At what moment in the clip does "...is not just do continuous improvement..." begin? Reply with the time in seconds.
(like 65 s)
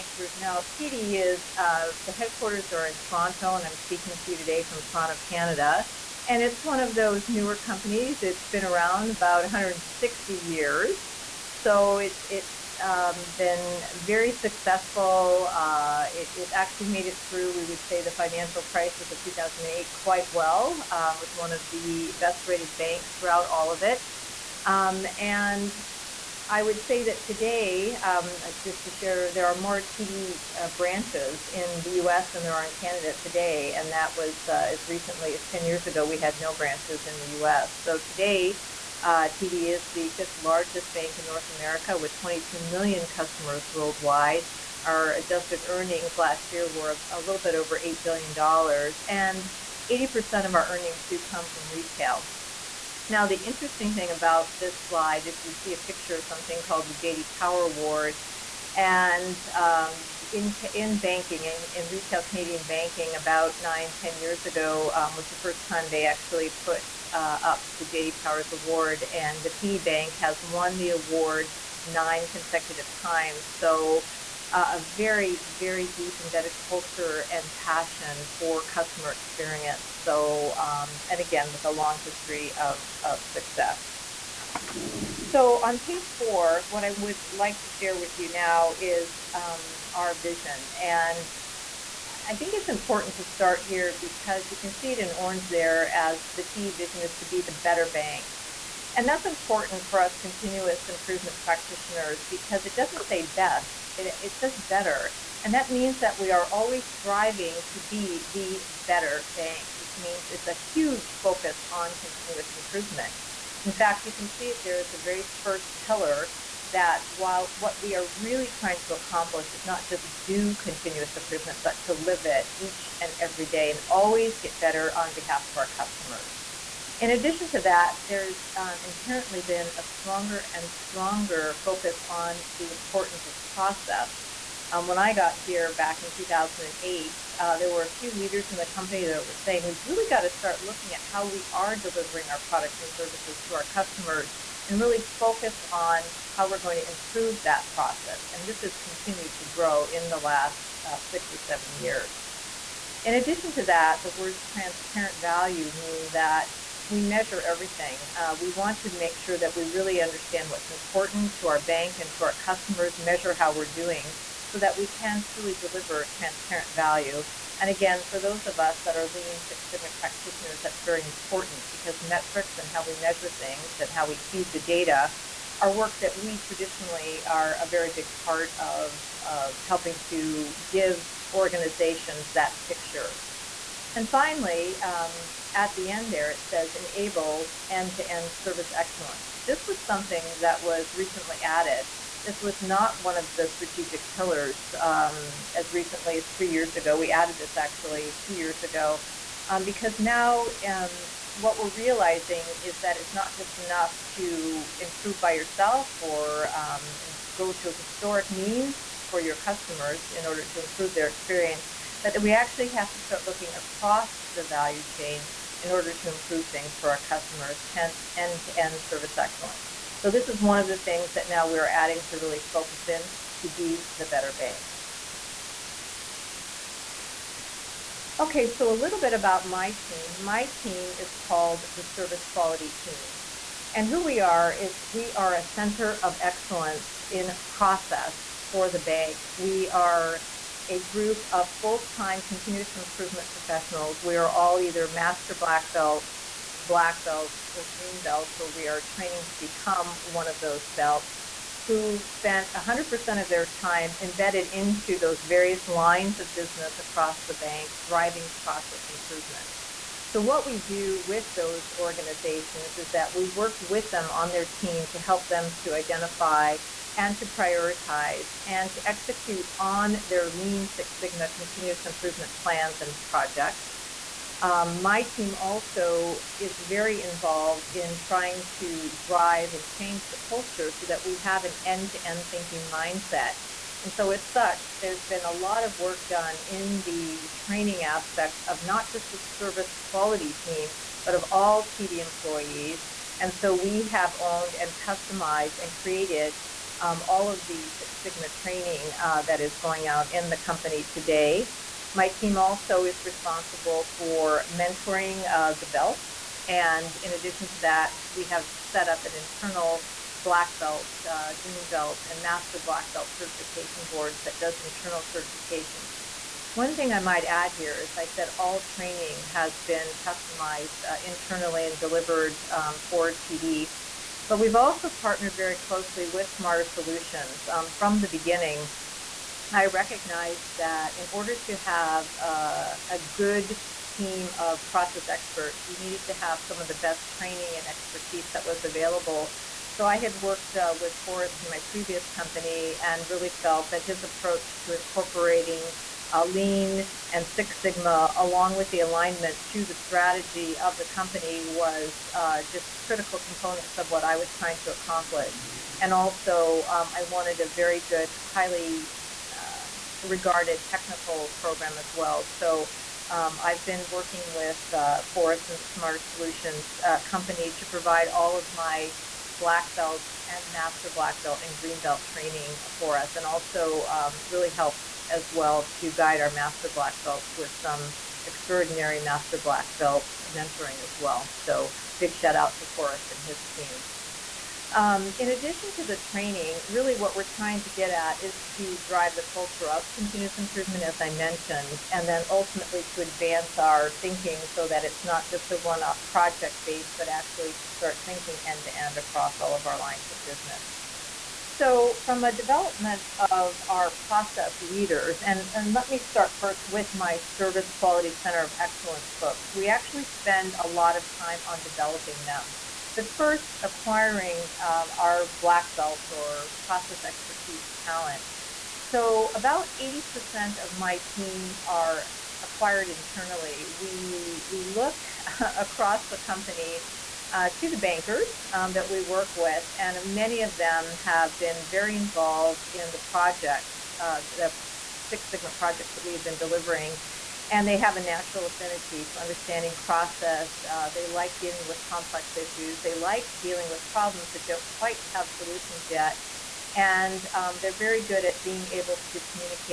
119 s.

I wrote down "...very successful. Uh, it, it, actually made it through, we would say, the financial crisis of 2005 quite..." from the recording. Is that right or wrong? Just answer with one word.
wrong.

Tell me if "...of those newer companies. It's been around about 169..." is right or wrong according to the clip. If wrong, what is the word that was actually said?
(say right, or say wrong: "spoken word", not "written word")
wrong: "160", not "169".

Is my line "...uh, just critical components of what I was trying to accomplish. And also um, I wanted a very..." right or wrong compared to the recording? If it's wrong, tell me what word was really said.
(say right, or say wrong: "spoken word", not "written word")
right.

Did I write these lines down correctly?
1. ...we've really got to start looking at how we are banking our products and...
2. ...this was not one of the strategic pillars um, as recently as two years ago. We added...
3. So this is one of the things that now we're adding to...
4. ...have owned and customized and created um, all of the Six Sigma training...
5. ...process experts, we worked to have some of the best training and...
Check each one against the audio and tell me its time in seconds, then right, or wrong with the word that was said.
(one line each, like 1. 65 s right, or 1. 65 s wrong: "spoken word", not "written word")
1. 139 s wrong: "delivering", not "banking"
2. 192 s wrong: "three", not "two"
3. 220 s right
4. 293 s right
5. 334 s wrong: "needed", not "worked".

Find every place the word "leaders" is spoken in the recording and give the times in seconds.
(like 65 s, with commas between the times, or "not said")
138 s, 404 s.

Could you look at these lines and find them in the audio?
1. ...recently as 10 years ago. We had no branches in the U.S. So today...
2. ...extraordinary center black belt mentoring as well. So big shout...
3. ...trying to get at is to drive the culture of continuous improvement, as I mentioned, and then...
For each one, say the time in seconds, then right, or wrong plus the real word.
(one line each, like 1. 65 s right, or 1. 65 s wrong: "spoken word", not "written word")
1. 34 s right
2. 378 s wrong: "master", not "center"
3. 387 s right.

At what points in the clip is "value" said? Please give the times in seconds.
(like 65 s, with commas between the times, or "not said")
155 s, 166 s, 214 s.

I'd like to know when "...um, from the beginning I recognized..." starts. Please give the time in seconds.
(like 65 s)
327 s.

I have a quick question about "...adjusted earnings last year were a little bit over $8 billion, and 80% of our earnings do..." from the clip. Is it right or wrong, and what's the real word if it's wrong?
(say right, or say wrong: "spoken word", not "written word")
right.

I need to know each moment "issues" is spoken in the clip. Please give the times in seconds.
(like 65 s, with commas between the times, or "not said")
442 s.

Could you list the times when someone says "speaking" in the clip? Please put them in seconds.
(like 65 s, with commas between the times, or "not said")
3 s.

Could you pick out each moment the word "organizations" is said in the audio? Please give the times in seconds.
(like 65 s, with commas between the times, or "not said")
181 s, 261 s.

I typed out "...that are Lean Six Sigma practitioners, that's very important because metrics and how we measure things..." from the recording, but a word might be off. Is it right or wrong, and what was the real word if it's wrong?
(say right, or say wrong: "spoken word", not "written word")
right.